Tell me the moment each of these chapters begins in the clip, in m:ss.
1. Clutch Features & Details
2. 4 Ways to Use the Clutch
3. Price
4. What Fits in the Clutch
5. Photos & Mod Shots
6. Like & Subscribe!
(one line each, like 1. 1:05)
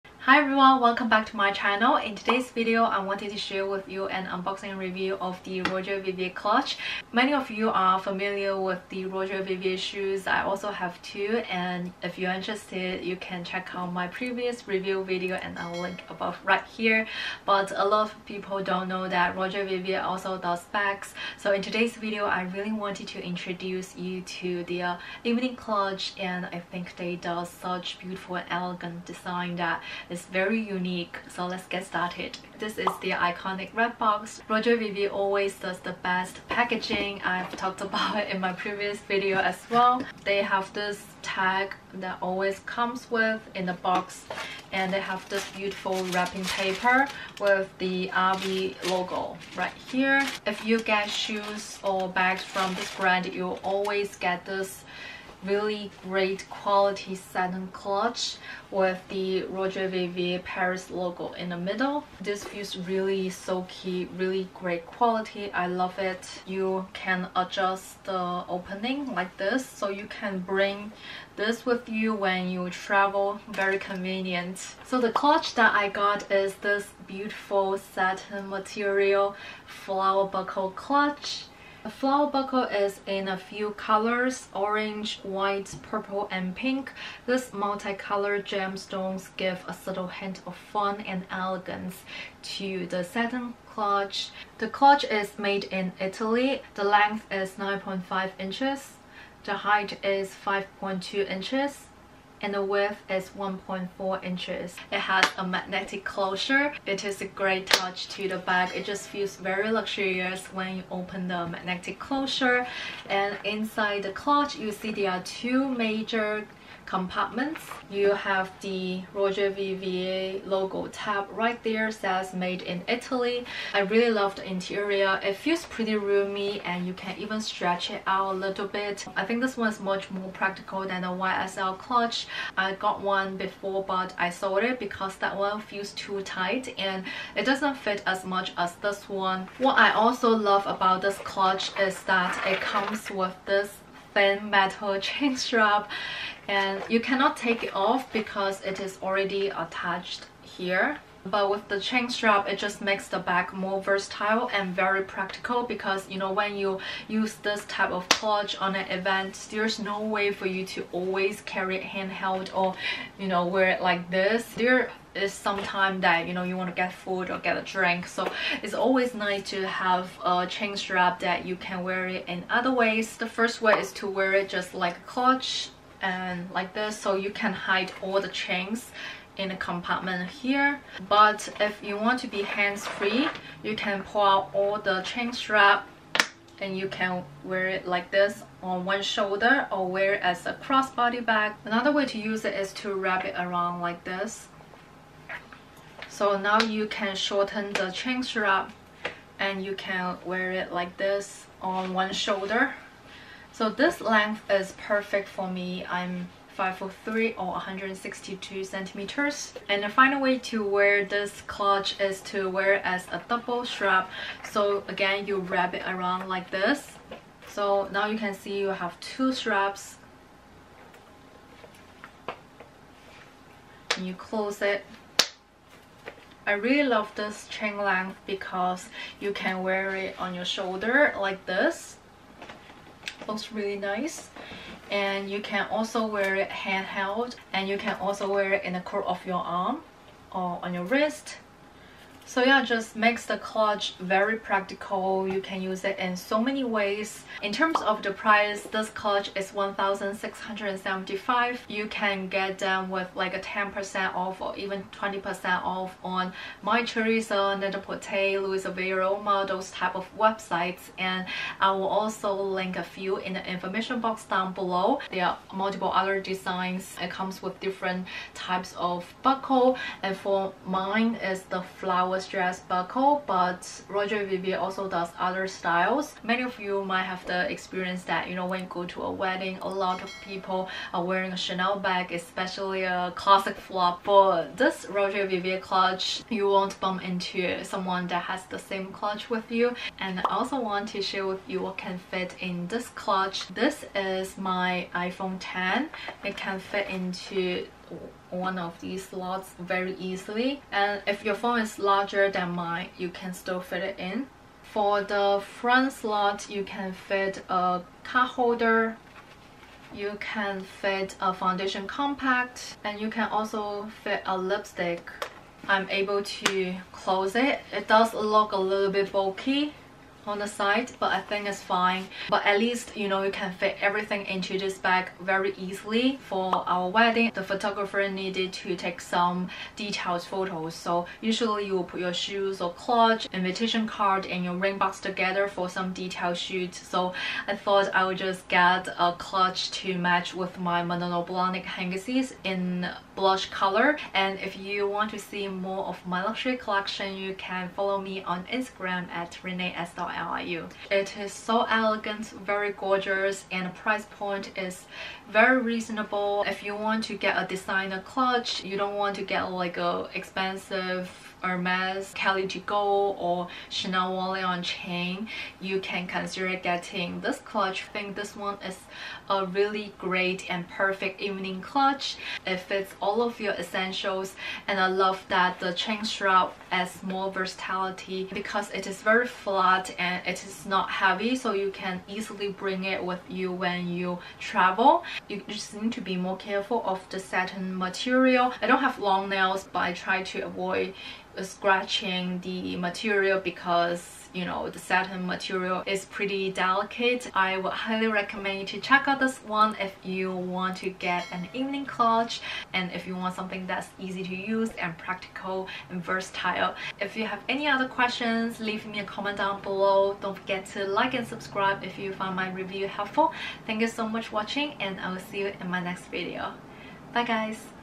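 1. 1:14
2. 2:53
3. 4:07
4. 4:50
5. 5:26
6. 6:37.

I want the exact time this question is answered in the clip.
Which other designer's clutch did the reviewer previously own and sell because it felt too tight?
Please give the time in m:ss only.
2:11.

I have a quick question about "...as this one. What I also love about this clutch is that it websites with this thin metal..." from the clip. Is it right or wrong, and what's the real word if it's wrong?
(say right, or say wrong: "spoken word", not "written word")
wrong: "comes", not "websites".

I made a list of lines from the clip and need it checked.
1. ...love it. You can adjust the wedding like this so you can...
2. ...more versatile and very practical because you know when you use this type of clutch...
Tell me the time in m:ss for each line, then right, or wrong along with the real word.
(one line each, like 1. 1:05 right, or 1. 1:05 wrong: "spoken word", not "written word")
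1. 1:05 wrong: "opening", not "wedding"
2. 2:33 right.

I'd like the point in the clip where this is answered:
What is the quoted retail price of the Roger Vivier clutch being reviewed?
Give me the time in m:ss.
4:09.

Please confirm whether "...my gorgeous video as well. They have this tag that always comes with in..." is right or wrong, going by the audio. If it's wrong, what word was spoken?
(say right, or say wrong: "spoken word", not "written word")
wrong: "previous", not "gorgeous".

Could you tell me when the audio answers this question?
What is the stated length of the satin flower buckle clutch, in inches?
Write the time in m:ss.
1:37.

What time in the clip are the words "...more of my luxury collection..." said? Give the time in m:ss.
5:45.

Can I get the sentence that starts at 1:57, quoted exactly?
You have the Roger Vivier logo tab right there says made in Italy.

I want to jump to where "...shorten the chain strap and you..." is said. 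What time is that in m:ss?
3:17.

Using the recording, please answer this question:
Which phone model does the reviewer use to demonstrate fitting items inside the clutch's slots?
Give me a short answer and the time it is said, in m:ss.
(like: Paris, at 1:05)
iPhone 10, at 4:54.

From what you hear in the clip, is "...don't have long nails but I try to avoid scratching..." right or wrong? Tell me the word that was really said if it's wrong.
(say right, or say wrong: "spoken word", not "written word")
right.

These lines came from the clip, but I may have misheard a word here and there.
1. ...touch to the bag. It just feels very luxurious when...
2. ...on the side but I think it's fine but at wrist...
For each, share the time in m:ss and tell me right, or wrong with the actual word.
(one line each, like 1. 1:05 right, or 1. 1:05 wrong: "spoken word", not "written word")
1. 1:47 right
2. 5:20 wrong: "least", not "wrist".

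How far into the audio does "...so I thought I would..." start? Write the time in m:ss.
5:36.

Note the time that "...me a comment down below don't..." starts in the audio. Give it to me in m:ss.
6:48.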